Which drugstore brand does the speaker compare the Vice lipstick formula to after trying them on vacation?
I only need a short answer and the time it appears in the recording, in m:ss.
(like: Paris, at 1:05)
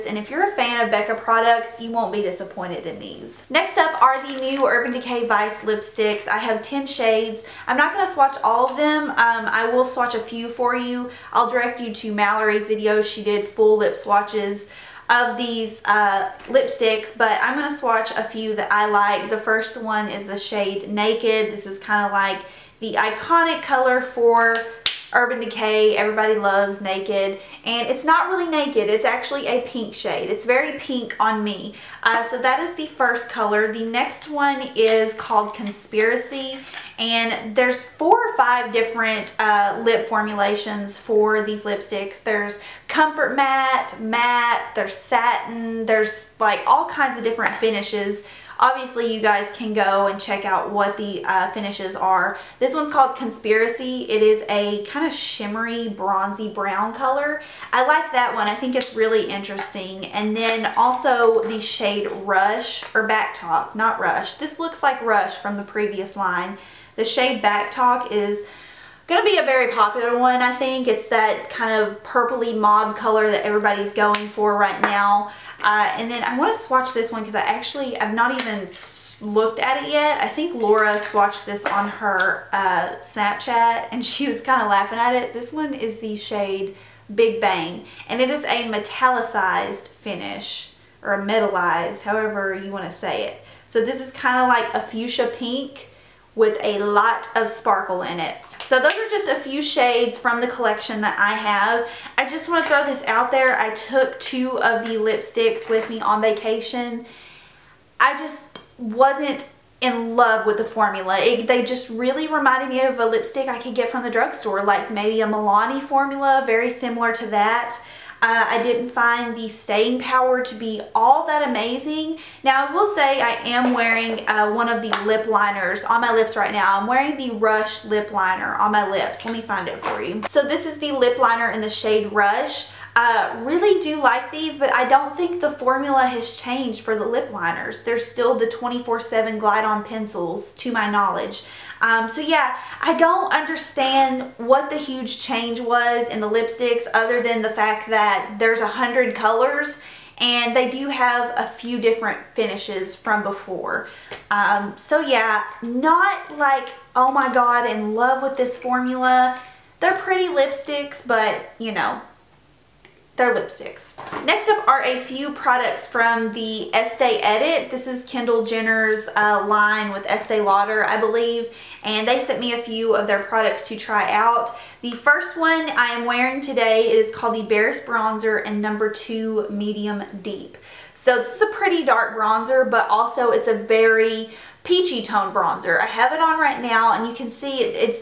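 Milani, at 1:55.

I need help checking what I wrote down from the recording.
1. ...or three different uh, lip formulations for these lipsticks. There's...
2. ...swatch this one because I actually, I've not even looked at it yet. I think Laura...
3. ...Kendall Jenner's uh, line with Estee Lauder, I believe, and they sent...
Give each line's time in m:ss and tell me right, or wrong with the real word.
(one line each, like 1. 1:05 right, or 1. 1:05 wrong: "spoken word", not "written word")
1. 0:38 wrong: "five", not "three"
2. 1:16 right
3. 2:48 right.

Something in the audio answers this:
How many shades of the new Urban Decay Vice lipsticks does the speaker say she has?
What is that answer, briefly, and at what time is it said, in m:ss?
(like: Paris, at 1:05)
10, at 0:06.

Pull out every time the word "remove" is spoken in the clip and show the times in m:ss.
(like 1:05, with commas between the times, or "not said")
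not said.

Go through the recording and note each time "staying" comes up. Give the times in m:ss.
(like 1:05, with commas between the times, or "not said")
1:59.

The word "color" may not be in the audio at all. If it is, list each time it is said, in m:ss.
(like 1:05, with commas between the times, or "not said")
0:23, 0:33, 0:56, 1:12, 2:29.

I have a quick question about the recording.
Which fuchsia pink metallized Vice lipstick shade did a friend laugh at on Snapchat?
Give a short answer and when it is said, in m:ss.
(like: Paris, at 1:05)
Big Bang, at 1:27.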